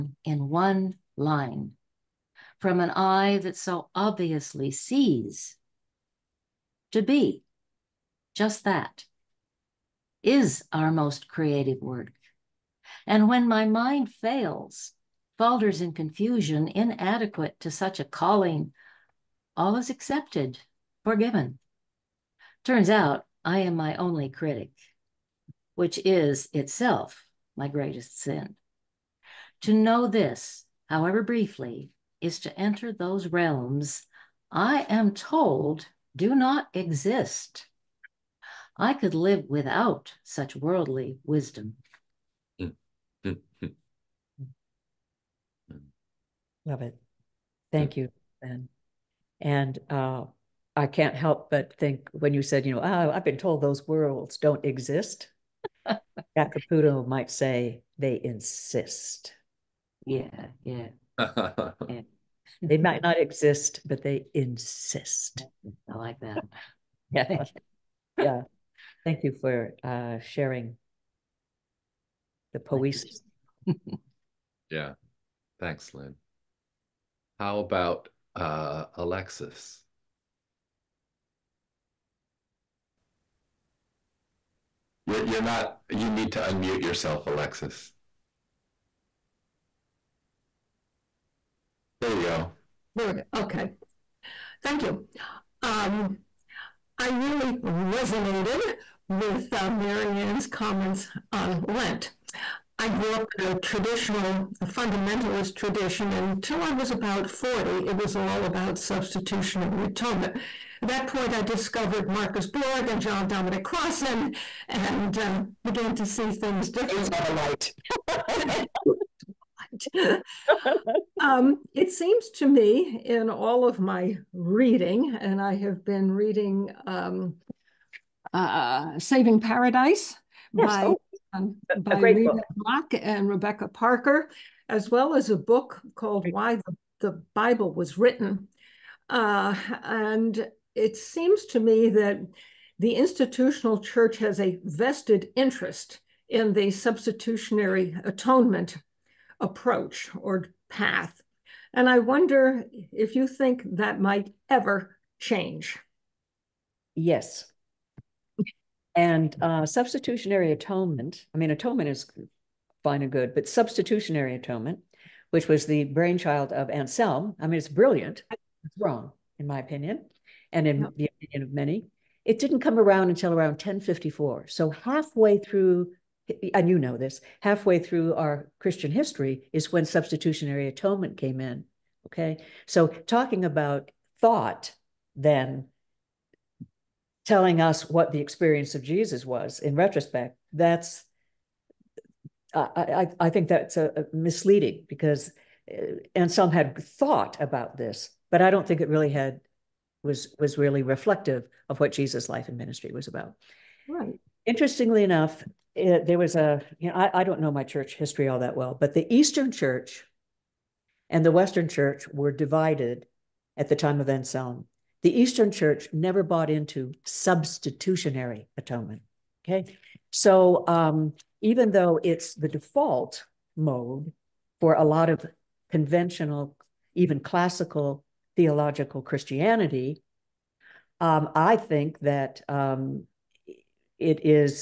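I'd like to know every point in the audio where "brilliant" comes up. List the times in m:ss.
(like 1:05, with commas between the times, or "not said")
2:47.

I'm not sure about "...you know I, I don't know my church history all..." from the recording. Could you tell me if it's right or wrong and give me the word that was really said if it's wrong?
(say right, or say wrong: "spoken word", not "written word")
right.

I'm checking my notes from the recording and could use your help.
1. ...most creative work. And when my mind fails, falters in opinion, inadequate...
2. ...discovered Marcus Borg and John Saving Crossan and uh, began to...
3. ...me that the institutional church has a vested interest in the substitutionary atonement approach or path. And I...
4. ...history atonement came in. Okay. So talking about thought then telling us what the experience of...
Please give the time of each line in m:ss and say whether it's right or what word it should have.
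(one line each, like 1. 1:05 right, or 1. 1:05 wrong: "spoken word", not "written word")
1. 0:10 wrong: "confusion", not "opinion"
2. 1:51 wrong: "Dominic", not "Saving"
3. 2:21 right
4. 2:59 wrong: "substitutionary", not "history".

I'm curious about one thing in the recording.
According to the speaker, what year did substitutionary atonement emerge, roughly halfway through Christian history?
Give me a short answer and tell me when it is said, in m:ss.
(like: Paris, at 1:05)
1054, at 2:53.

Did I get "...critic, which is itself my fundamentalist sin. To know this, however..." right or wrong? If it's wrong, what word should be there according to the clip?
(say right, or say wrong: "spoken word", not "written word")
wrong: "greatest", not "fundamentalist".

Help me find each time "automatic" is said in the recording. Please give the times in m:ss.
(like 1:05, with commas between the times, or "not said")
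not said.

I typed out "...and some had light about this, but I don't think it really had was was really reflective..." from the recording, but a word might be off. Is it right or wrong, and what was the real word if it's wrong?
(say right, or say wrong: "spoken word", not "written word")
wrong: "thought", not "light".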